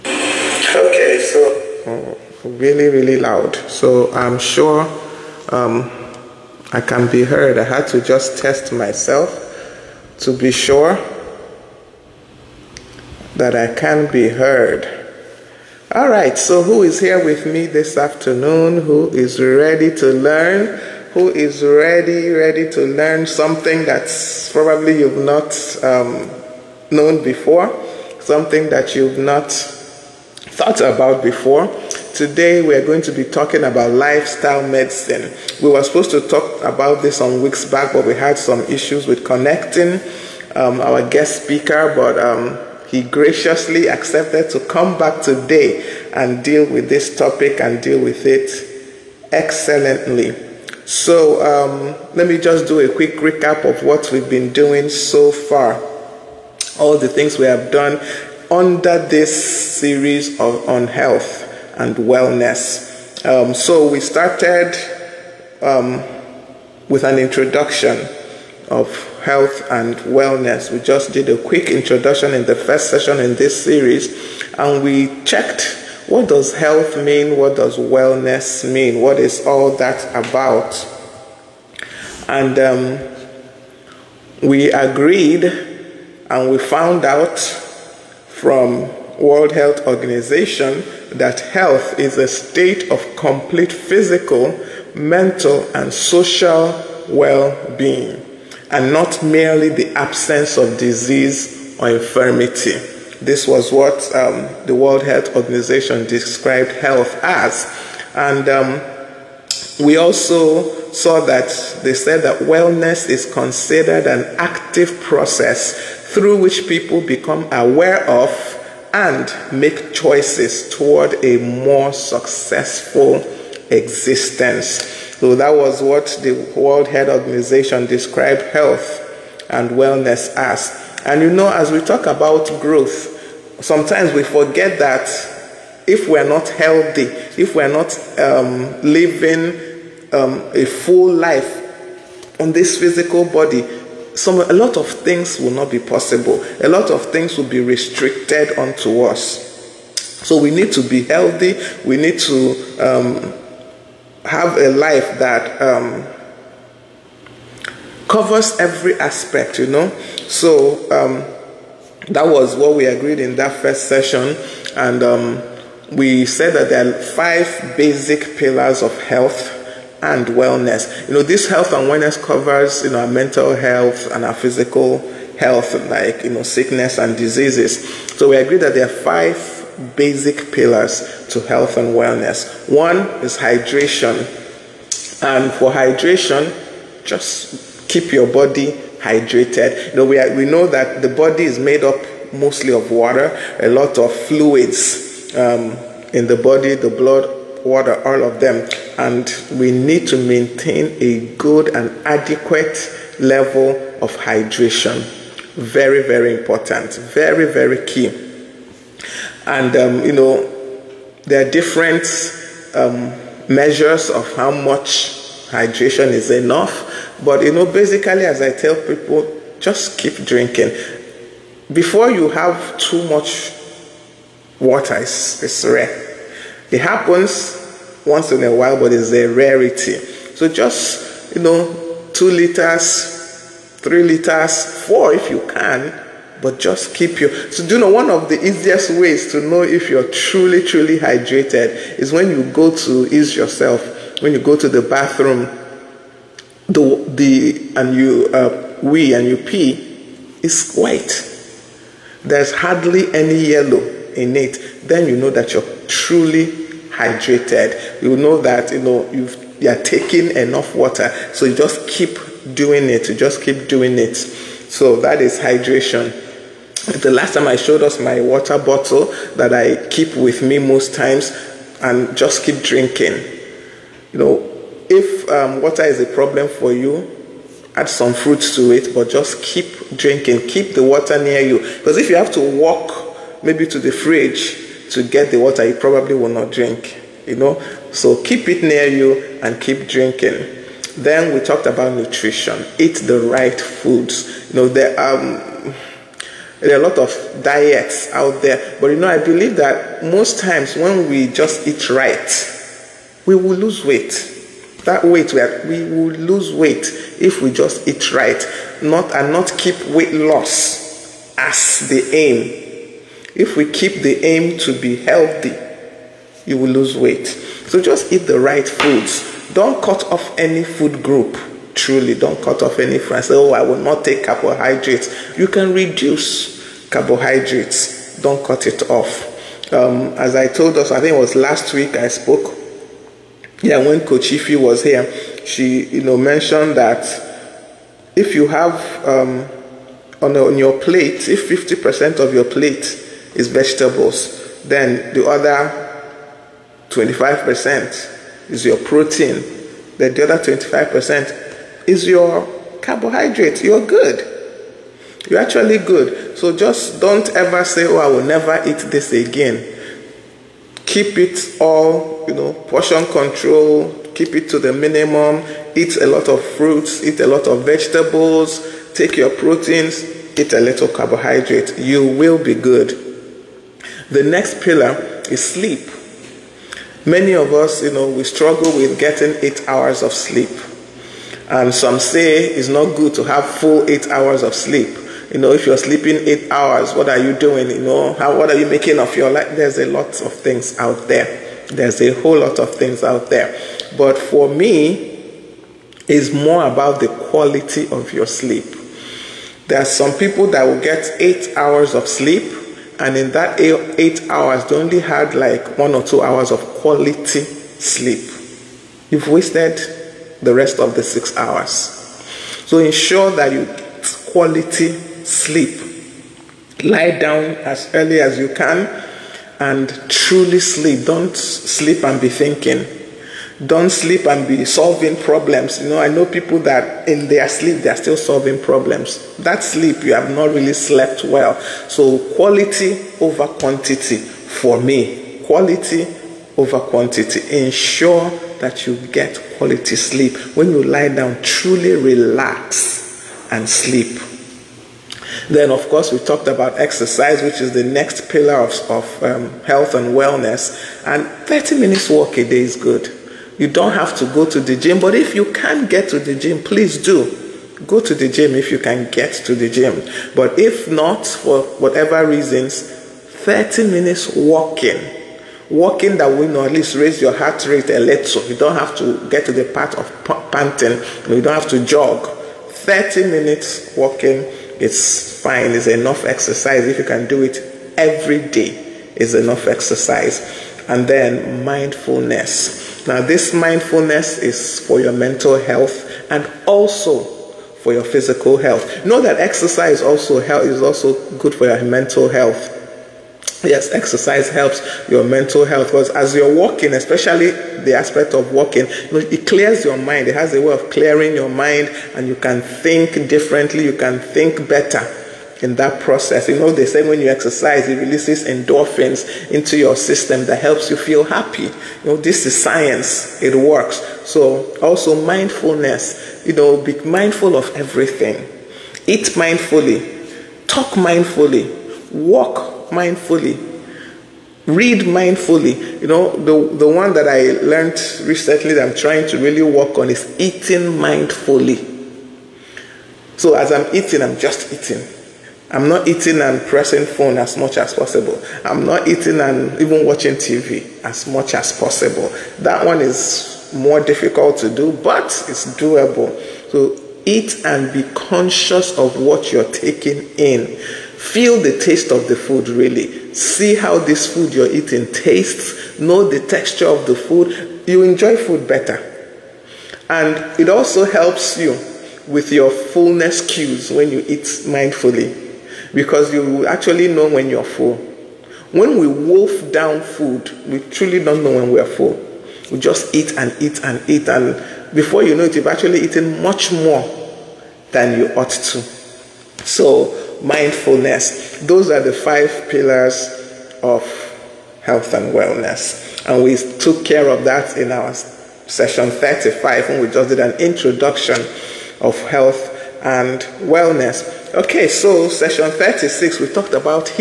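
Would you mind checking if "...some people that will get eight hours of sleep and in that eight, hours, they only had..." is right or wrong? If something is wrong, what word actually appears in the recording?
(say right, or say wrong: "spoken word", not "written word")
right.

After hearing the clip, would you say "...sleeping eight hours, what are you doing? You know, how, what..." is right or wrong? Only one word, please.
right.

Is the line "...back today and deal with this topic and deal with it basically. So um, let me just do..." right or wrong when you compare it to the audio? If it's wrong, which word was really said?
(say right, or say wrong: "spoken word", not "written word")
wrong: "excellently", not "basically".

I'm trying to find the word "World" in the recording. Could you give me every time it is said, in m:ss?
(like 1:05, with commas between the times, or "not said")
1:29, 1:44, 2:06.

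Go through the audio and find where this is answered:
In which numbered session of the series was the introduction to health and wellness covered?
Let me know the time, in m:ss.
9:48.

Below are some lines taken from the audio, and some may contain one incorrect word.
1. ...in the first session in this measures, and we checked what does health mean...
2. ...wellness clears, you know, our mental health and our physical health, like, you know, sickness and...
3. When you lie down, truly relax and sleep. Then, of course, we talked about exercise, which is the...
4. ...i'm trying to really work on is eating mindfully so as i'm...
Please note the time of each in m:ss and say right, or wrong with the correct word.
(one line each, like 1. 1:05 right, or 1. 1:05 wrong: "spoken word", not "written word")
1. 1:12 wrong: "series", not "measures"
2. 2:51 wrong: "covers", not "clears"
3. 7:20 right
4. 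8:48 right.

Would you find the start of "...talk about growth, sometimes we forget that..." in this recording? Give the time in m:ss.
2:11.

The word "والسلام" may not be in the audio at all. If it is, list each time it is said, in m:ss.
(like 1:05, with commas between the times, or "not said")
not said.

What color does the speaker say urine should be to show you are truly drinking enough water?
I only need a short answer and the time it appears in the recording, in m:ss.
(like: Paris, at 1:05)
White, at 4:10.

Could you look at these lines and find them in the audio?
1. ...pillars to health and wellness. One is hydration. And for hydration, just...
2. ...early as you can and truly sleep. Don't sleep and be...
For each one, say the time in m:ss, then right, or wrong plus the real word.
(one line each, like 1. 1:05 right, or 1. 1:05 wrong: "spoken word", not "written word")
1. 3:00 right
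2. 6:57 right.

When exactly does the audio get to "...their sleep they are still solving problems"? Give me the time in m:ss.
7:07.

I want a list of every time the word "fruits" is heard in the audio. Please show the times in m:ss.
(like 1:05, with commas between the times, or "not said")
4:38, 6:06.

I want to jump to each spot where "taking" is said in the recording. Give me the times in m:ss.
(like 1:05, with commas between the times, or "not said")
4:19, 9:09.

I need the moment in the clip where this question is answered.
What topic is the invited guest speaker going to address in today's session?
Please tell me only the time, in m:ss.
0:33.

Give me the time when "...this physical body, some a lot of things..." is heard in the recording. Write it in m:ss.
2:22.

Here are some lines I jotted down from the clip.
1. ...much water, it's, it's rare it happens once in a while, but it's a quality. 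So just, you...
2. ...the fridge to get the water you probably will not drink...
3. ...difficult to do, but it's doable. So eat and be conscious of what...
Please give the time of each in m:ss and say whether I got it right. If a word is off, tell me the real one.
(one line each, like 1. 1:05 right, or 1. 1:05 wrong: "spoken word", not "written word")
1. 3:43 wrong: "rarity", not "quality"
2. 4:43 right
3. 9:03 right.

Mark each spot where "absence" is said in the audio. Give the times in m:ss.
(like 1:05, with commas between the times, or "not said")
1:39.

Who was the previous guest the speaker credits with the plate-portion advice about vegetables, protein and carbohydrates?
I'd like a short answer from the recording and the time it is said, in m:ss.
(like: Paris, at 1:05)
Kochifi, at 5:34.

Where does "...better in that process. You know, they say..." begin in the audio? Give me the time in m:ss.
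8:24.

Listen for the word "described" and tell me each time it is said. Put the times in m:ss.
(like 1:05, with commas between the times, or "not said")
1:46, 2:07.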